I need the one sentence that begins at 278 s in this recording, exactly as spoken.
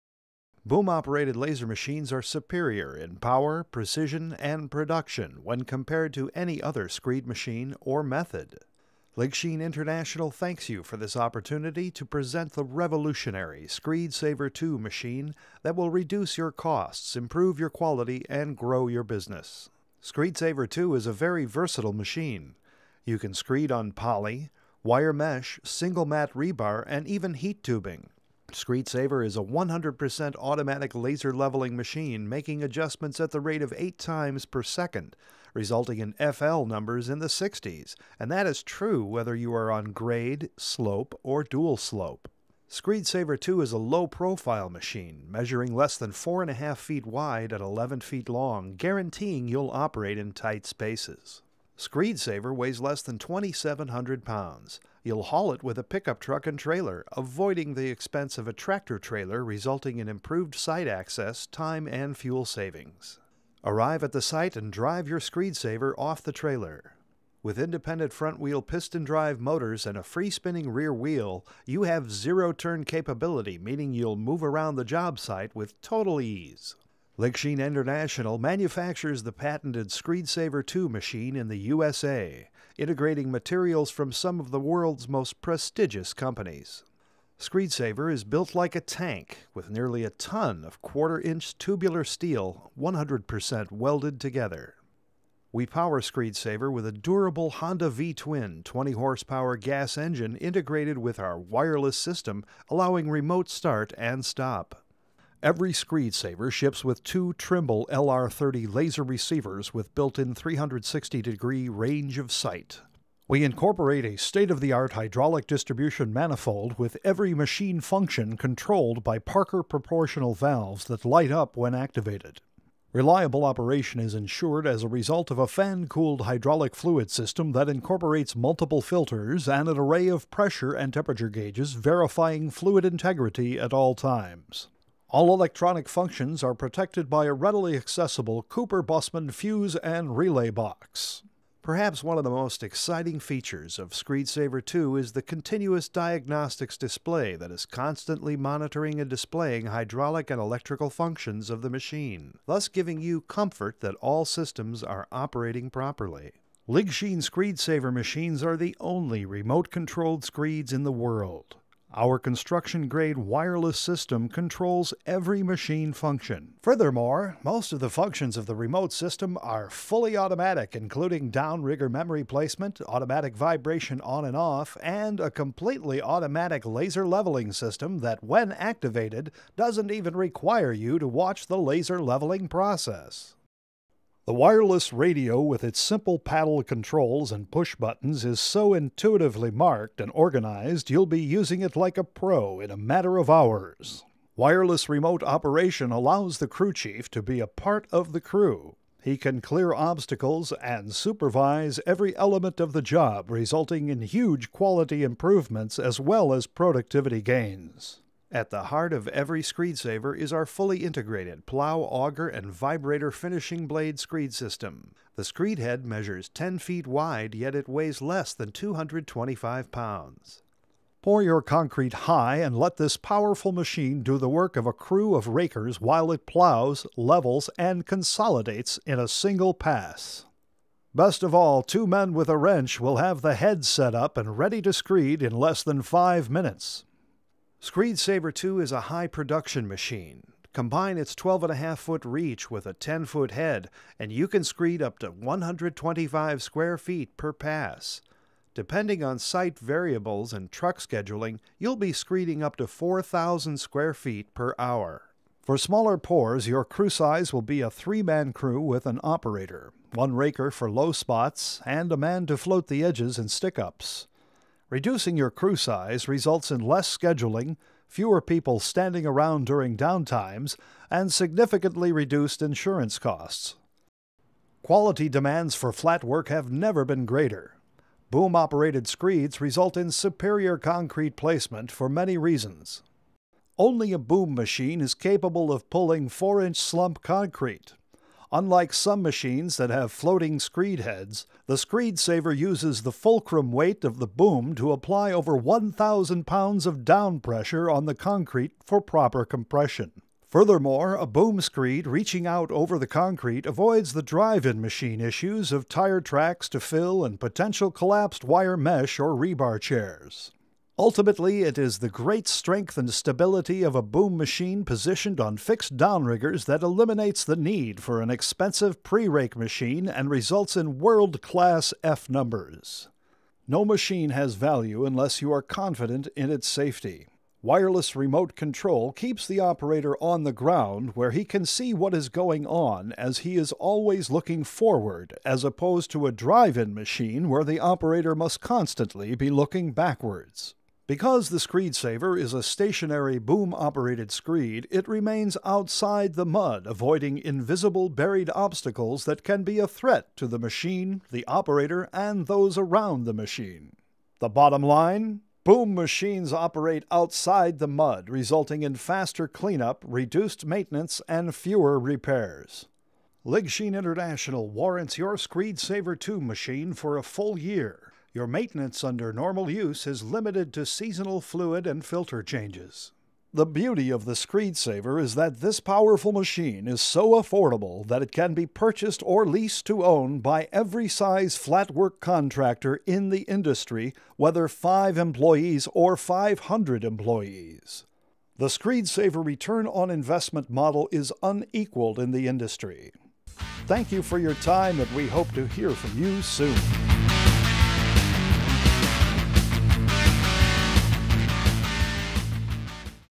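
Boom operated screeds result in superior concrete placement for many reasons.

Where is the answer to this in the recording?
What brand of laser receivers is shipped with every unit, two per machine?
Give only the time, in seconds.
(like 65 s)
107 s.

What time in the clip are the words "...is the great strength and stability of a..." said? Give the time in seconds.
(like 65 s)
311 s.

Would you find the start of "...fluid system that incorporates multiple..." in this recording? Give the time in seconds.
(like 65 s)
126 s.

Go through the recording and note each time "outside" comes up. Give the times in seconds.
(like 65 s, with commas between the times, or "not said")
345 s, 356 s.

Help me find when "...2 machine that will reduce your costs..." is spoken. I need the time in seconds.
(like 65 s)
14 s.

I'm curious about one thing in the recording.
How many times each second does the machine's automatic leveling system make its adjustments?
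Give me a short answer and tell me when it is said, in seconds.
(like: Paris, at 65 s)
8, at 33 s.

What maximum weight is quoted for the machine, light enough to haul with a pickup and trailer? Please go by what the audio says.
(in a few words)
2,700 pounds.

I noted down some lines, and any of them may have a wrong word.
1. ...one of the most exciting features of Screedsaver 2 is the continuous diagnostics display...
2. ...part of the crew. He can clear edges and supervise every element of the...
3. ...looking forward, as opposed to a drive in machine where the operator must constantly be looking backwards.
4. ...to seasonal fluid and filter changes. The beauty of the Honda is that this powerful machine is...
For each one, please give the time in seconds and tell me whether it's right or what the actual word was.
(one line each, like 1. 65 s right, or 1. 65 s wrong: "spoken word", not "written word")
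1. 142 s right
2. 197 s wrong: "obstacles", not "edges"
3. 334 s right
4. 370 s wrong: "Screedsaver", not "Honda".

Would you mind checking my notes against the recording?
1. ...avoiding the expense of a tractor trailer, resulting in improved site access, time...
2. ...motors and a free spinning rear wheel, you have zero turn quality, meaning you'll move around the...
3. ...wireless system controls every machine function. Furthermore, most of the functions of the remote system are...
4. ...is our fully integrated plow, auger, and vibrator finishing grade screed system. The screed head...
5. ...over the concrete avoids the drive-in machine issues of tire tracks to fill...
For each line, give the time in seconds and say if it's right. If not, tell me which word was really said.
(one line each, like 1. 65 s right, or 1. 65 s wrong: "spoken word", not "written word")
1. 57 s right
2. 69 s wrong: "capability", not "quality"
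3. 163 s right
4. 210 s wrong: "blade", not "grade"
5. 302 s right.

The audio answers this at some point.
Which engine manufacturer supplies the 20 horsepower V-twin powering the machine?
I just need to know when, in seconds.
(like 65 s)
97 s.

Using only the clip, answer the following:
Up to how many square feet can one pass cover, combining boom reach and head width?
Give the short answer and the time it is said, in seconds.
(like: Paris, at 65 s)
125, at 245 s.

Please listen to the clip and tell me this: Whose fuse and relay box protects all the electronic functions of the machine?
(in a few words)
Cooper Bussmann.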